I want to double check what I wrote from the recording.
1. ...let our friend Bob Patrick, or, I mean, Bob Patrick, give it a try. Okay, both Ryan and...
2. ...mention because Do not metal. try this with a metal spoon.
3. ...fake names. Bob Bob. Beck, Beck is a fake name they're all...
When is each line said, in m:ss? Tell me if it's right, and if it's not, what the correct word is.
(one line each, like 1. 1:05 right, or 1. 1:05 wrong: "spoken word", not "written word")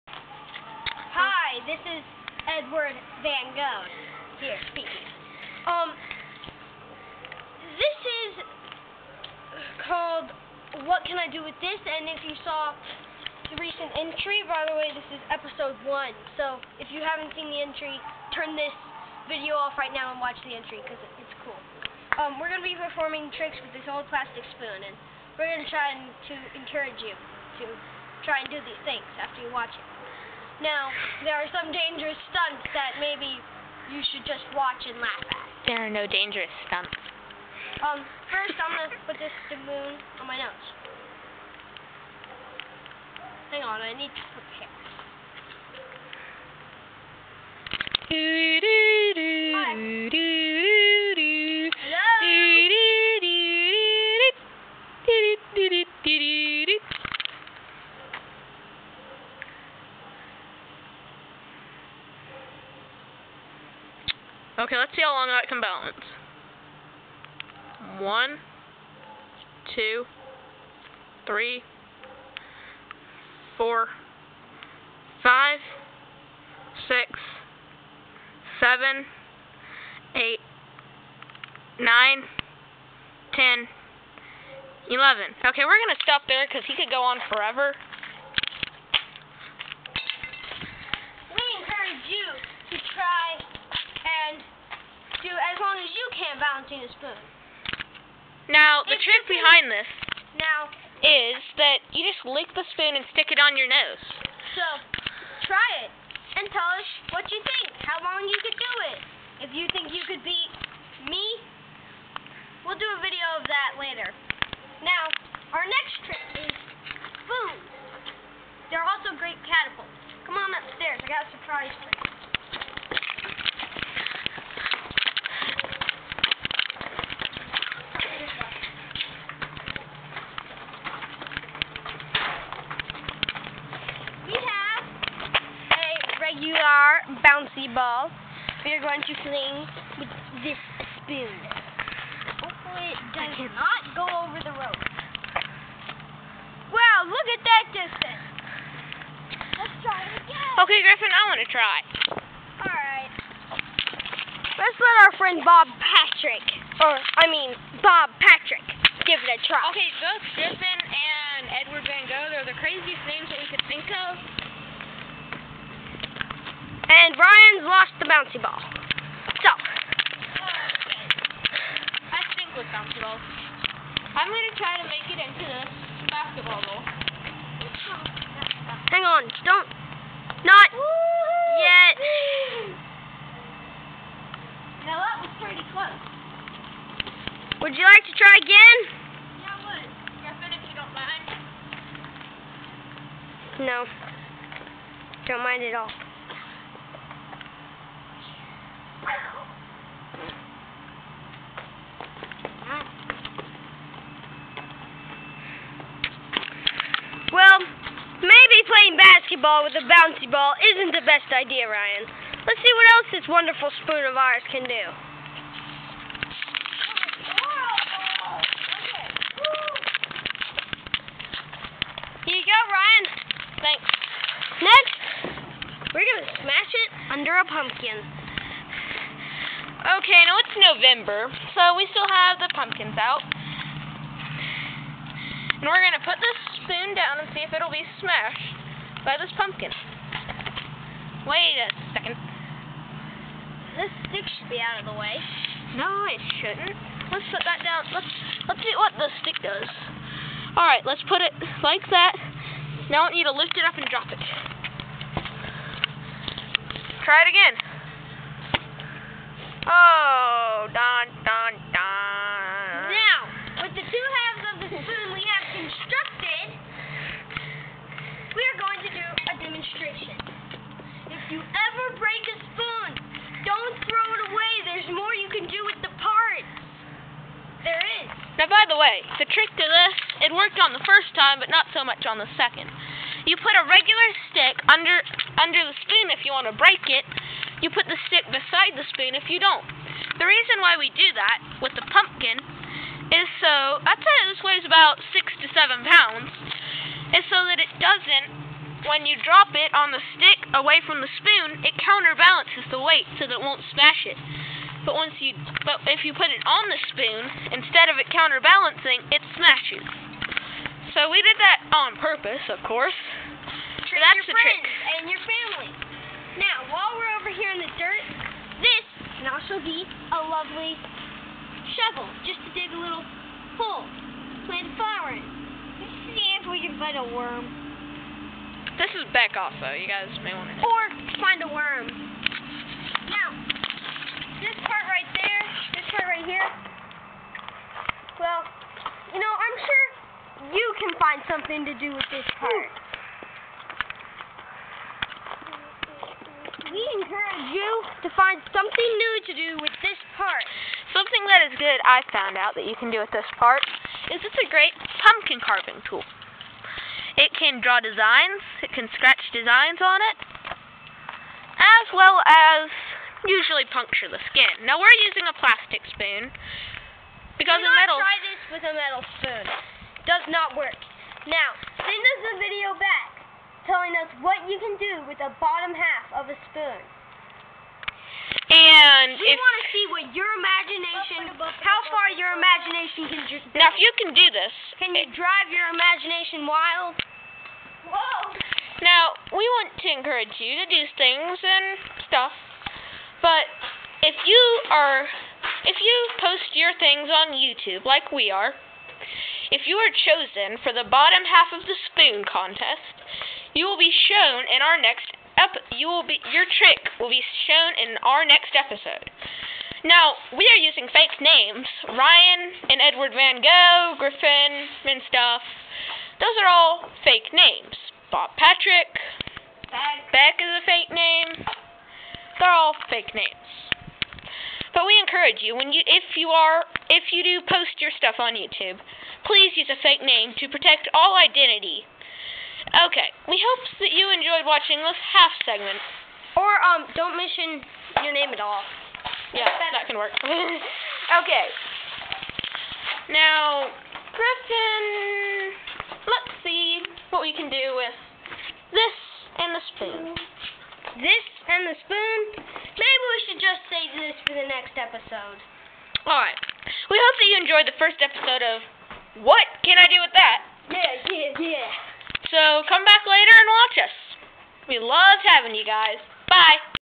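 1. 2:34 wrong: "Griffin", not "Ryan"
2. 6:05 wrong: "spoon", not "mention"
3. 6:57 wrong: "Patrick", not "Bob".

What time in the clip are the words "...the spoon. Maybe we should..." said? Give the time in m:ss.
7:31.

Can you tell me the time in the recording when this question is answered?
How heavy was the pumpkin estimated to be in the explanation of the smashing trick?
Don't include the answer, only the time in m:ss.
4:55.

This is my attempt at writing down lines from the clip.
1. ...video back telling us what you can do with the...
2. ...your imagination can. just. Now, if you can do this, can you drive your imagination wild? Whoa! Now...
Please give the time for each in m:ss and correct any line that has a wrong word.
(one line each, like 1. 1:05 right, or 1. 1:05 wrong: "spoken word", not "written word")
1. 6:12 right
2. 6:22 right.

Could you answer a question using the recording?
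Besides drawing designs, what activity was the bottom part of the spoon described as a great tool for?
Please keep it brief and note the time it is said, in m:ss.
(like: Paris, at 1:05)
Pumpkin carving, at 5:55.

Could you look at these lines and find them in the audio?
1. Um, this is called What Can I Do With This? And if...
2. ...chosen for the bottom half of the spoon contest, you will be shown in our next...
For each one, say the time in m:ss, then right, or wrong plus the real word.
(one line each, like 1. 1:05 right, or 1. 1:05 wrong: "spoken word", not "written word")
1. 0:05 right
2. 6:39 right.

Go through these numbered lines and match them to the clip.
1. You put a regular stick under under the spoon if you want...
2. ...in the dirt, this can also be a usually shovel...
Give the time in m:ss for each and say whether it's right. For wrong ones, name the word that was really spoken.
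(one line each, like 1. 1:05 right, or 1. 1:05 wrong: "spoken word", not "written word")
1. 4:43 right
2. 5:17 wrong: "lovely", not "usually".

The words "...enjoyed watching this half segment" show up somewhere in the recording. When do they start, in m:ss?
7:14.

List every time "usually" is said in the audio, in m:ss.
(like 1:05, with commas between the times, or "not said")
6:03.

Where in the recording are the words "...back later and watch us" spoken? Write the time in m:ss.
7:42.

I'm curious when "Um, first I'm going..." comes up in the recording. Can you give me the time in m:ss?
0:37.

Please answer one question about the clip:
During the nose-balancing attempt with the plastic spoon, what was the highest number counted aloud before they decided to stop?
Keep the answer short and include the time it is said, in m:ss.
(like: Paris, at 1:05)
11, at 1:24.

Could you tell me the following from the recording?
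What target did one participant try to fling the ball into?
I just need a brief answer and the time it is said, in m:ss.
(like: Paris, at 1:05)
Basketball goal, at 2:56.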